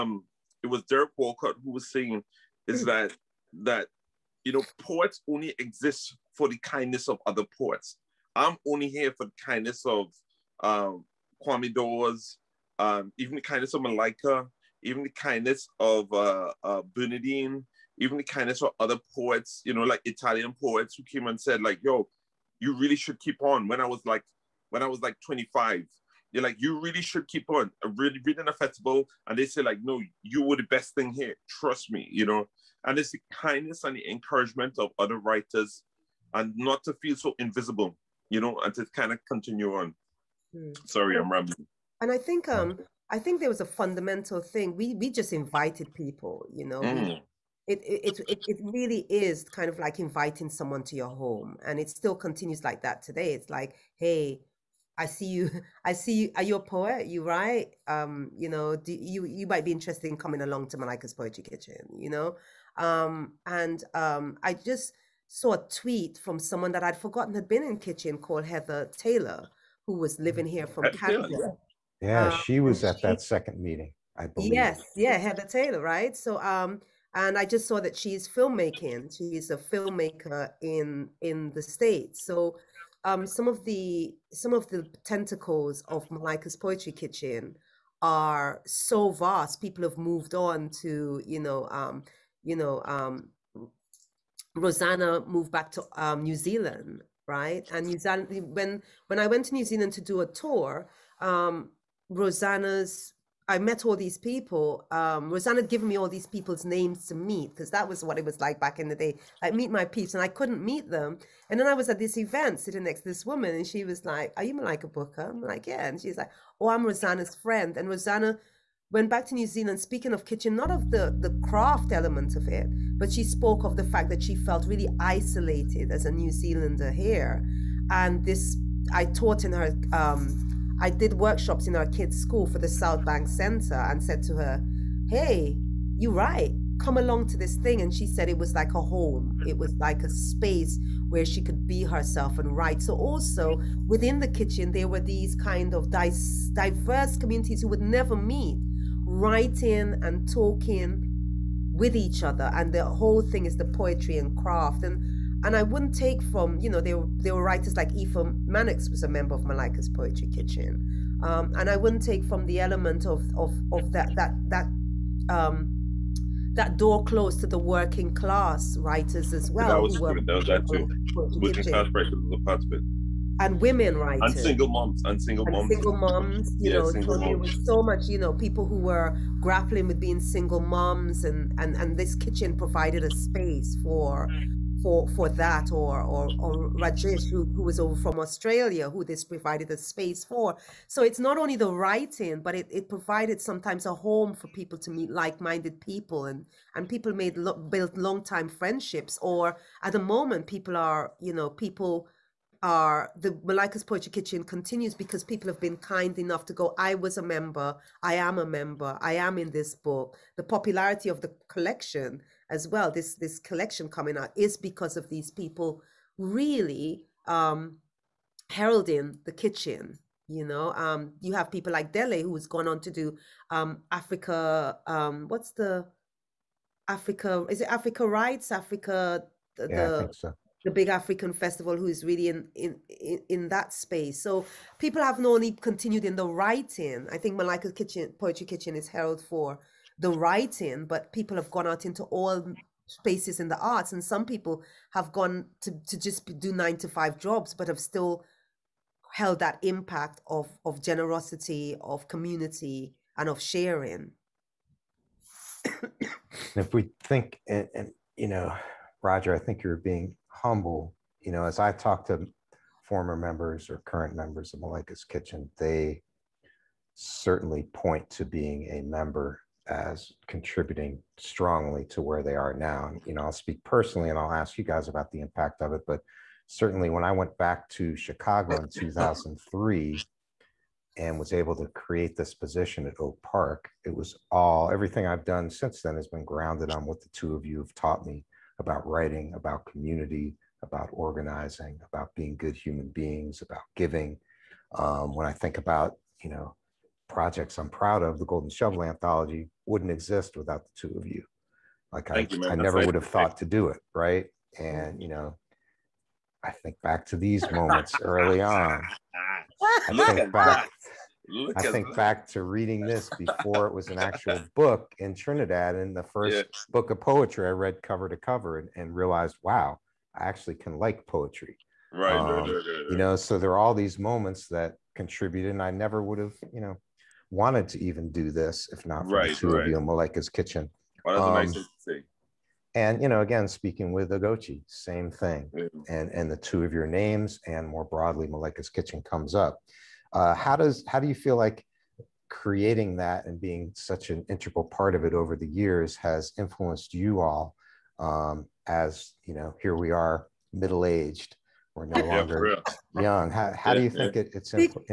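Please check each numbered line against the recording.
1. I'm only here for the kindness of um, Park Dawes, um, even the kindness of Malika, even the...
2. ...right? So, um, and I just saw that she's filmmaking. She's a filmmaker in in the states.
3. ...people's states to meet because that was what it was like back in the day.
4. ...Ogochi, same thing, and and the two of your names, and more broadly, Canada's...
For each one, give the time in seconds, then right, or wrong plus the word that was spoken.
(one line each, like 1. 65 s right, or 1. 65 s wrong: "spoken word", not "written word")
1. 8 s wrong: "Kwame", not "Park"
2. 75 s right
3. 106 s wrong: "names", not "states"
4. 334 s wrong: "Maleka", not "Canada".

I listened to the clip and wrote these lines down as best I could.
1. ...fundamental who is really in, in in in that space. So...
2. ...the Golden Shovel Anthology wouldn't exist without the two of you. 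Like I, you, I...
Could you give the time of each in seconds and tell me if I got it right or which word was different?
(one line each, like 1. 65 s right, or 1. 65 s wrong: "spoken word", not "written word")
1. 231 s wrong: "festival", not "fundamental"
2. 298 s right.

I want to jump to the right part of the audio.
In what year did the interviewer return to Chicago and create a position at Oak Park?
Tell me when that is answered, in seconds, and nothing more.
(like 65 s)
278 s.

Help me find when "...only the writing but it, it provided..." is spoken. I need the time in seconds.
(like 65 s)
191 s.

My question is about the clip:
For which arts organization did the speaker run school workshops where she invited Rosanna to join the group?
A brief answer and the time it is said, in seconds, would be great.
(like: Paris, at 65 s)
South Bank Center, at 132 s.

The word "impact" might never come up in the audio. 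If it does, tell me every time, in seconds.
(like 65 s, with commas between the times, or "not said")
249 s, 275 s.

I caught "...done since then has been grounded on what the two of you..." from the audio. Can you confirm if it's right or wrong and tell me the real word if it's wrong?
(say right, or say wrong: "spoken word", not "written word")
right.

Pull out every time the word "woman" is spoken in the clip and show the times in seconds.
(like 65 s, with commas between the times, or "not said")
113 s.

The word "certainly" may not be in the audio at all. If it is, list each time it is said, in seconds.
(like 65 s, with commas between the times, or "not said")
266 s, 276 s.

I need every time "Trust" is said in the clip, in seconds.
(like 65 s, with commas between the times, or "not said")
31 s.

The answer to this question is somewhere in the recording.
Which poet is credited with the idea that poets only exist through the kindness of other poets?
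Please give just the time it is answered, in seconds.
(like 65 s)
0 s.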